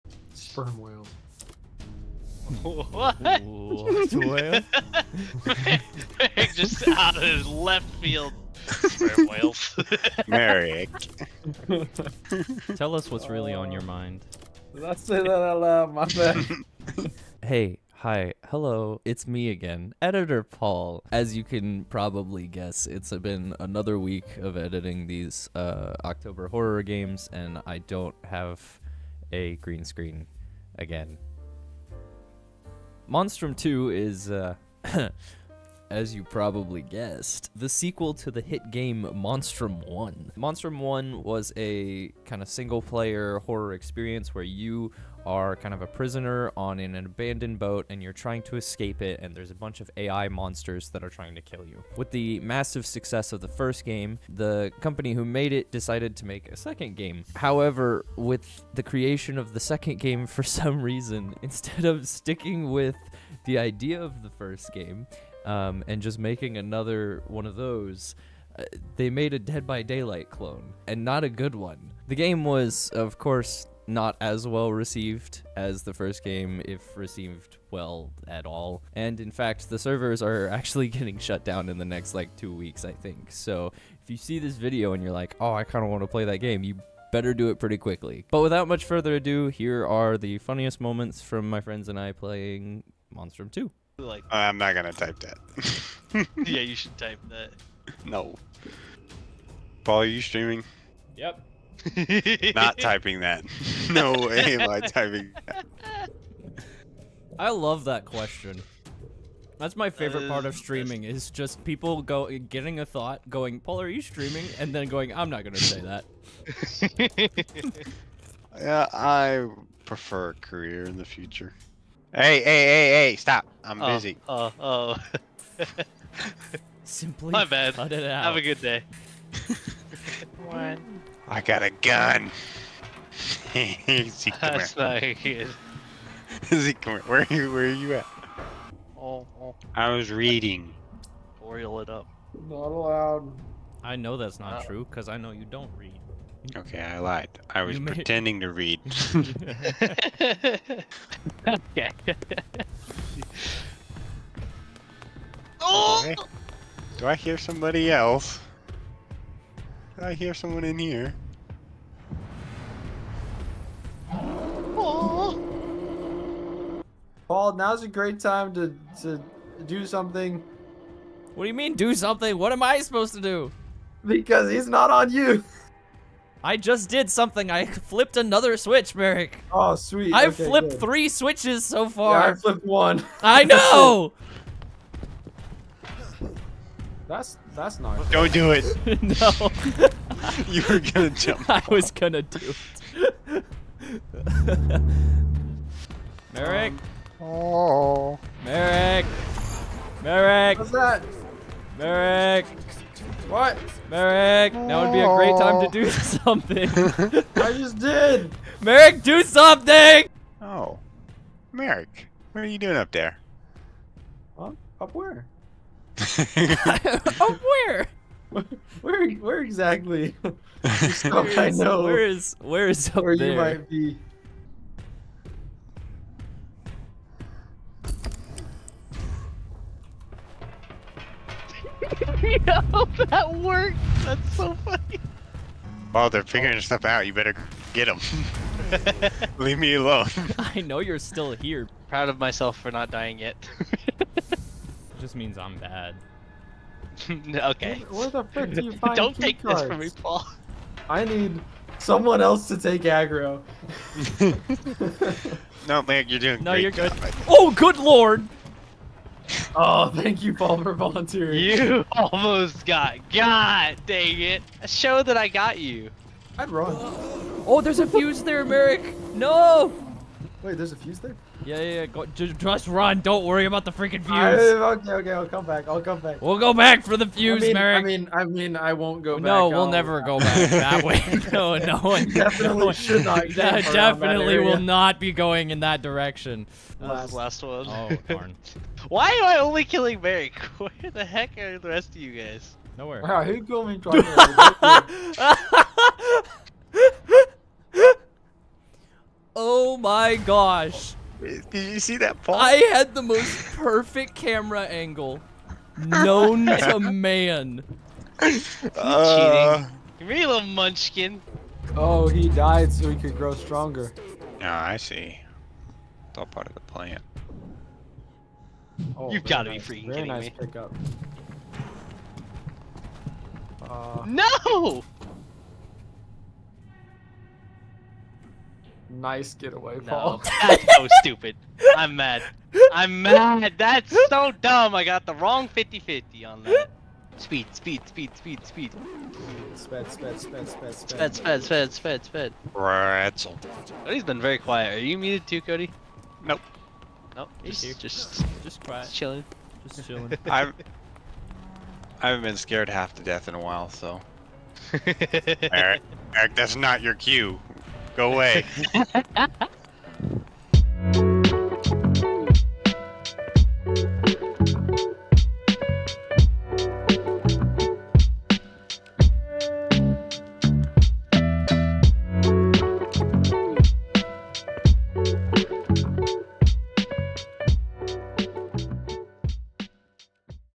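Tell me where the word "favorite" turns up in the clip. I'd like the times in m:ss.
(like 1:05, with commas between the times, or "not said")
1:49.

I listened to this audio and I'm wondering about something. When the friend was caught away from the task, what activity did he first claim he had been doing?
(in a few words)
Reading.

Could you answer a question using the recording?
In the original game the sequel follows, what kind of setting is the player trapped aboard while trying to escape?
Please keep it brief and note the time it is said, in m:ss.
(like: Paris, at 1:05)
An abandoned boat, at 0:46.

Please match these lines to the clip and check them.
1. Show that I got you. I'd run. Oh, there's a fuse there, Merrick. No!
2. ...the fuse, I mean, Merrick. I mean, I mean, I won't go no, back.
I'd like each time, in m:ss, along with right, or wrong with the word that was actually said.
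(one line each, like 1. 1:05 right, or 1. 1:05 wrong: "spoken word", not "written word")
1. 4:24 right
2. 4:36 right.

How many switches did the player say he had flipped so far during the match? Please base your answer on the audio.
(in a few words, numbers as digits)
3.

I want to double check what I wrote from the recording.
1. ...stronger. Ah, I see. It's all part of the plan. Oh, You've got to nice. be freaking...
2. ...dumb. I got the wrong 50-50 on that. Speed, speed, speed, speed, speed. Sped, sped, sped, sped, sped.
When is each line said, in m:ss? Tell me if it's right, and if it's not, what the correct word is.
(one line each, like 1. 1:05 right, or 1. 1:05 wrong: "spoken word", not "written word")
1. 5:13 right
2. 5:34 right.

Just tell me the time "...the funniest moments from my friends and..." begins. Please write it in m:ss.
1:30.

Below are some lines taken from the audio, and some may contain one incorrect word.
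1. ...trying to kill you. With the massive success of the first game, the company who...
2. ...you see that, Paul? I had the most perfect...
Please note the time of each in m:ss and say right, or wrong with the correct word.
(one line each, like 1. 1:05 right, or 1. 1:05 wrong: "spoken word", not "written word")
1. 0:51 right
2. 5:01 right.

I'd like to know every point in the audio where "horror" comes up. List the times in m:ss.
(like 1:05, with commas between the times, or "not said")
0:26, 0:43.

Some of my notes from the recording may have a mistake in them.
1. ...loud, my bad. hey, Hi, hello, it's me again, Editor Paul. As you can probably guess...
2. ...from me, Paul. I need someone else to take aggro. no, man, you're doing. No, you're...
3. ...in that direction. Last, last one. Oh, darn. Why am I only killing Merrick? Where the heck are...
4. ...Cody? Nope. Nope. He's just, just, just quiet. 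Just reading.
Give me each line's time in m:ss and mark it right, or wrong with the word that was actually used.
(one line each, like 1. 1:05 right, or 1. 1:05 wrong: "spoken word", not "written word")
1. 0:15 right
2. 4:09 right
3. 4:45 right
4. 5:45 wrong: "chilling", not "reading".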